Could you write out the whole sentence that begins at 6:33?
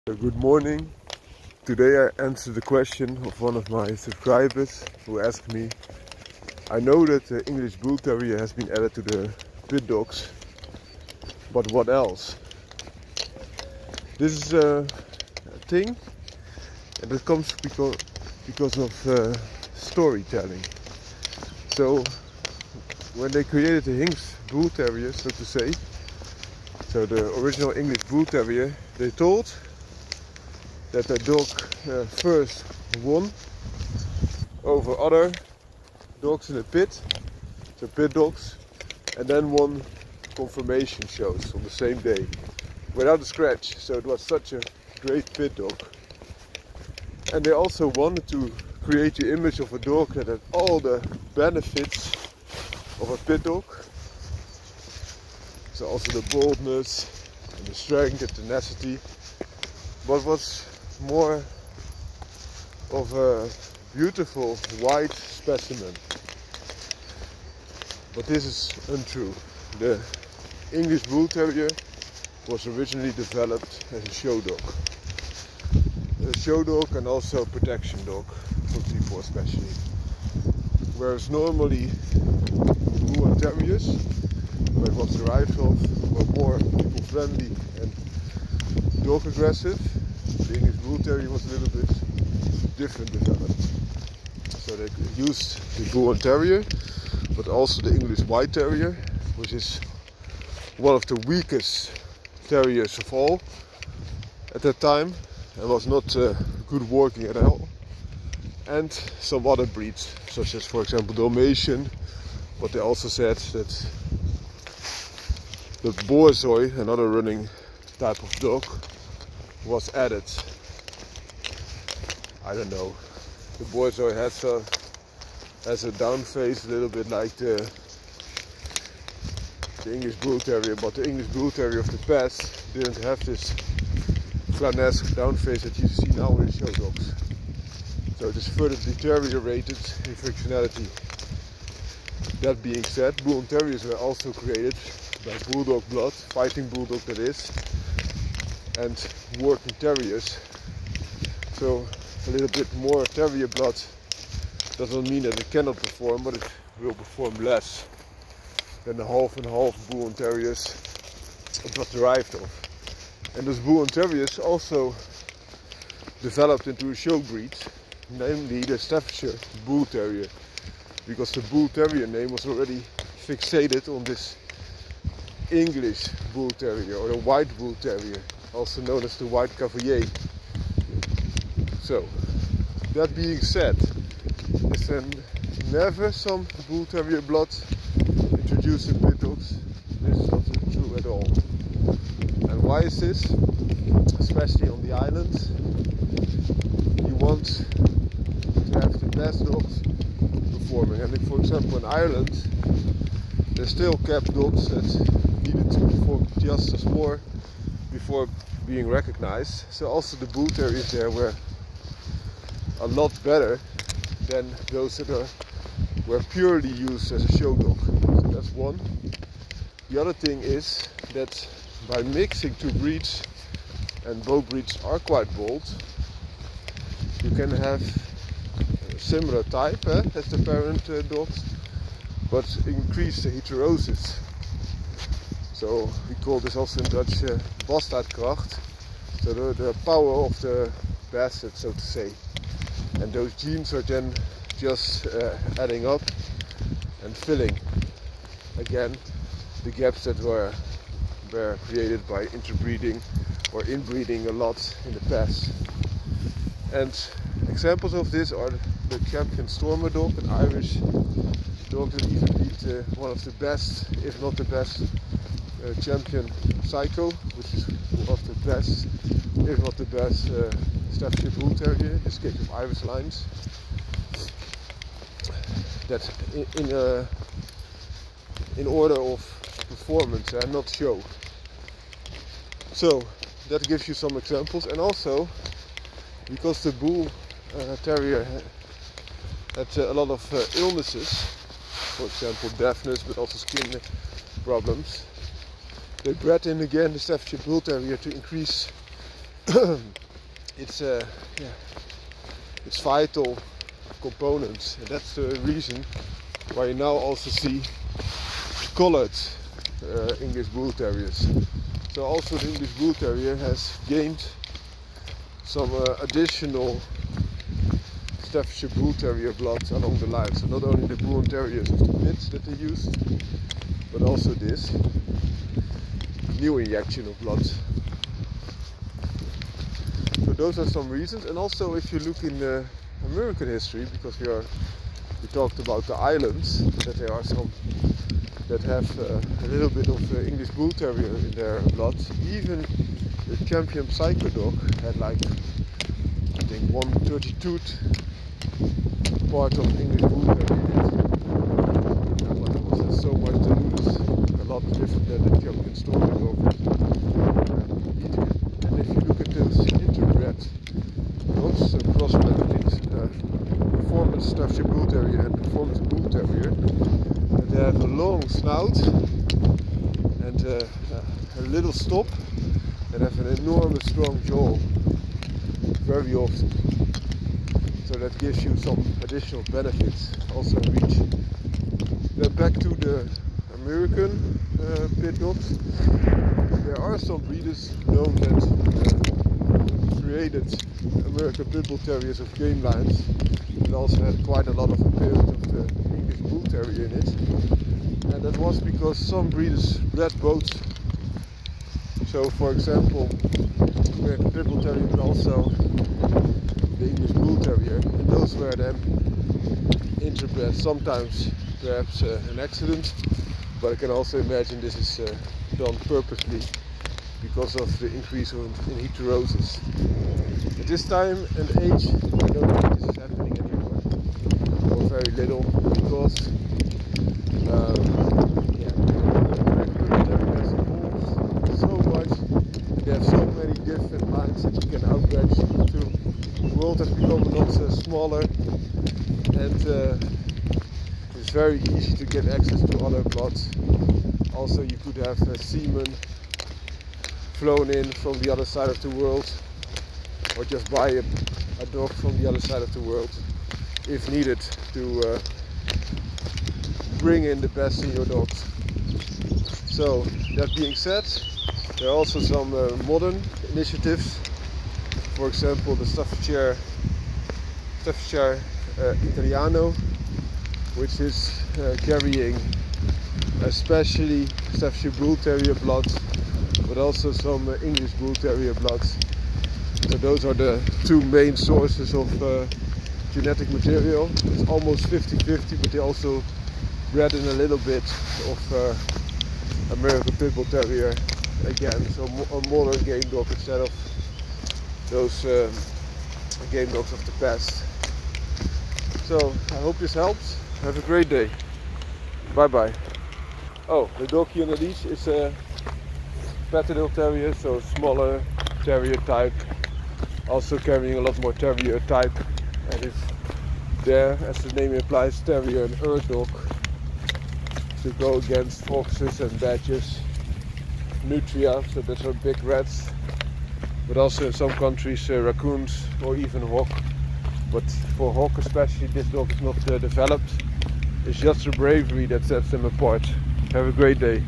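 It also had quite a lot of appearance of the English Bull Terrier in it.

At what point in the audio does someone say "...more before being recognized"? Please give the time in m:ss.
3:26.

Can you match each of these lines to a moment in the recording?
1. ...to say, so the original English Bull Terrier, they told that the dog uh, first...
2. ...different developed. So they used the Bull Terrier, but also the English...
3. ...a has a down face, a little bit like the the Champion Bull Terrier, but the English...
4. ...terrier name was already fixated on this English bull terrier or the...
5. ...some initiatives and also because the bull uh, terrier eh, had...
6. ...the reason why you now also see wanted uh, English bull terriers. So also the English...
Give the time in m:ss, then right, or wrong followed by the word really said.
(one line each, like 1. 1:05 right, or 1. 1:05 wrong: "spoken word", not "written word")
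1. 0:25 right
2. 1:32 right
3. 2:04 wrong: "English", not "Champion"
4. 2:51 right
5. 4:43 wrong: "examples", not "initiatives"
6. 5:05 wrong: "coloured", not "wanted".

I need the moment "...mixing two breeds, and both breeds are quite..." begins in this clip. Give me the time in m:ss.
3:42.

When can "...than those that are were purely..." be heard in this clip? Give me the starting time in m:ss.
3:34.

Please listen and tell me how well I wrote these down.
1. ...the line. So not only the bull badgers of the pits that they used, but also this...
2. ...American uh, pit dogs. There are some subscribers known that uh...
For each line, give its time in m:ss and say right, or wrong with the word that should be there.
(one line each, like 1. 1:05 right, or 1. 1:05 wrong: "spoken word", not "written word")
1. 5:19 wrong: "terriers", not "badgers"
2. 6:23 wrong: "breeders", not "subscribers".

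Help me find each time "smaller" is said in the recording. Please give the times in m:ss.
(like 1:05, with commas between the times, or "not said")
7:17, 8:27.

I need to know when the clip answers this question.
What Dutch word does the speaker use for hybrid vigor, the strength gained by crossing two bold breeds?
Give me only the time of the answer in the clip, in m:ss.
3:57.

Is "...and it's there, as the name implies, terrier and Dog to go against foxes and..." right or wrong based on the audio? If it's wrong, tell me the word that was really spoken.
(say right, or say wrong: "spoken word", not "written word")
right.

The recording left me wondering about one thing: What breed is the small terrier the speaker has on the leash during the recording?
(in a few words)
Patterdale Terrier.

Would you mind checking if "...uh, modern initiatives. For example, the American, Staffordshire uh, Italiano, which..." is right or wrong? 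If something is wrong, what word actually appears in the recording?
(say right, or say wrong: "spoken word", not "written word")
wrong: "Staffordshire", not "American".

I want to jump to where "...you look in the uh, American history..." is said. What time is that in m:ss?
5:31.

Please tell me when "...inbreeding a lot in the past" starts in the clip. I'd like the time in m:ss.
4:13.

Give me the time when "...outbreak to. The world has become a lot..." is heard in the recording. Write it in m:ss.
7:14.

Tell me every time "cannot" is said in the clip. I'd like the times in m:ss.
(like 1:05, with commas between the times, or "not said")
2:35.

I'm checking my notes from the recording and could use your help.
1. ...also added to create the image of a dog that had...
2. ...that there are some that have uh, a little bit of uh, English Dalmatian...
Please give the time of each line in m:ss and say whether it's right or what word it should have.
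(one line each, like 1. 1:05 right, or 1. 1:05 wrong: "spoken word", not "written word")
1. 0:47 wrong: "wanted", not "added"
2. 5:36 wrong: "Bull", not "Dalmatian".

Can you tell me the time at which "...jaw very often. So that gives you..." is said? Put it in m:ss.
6:14.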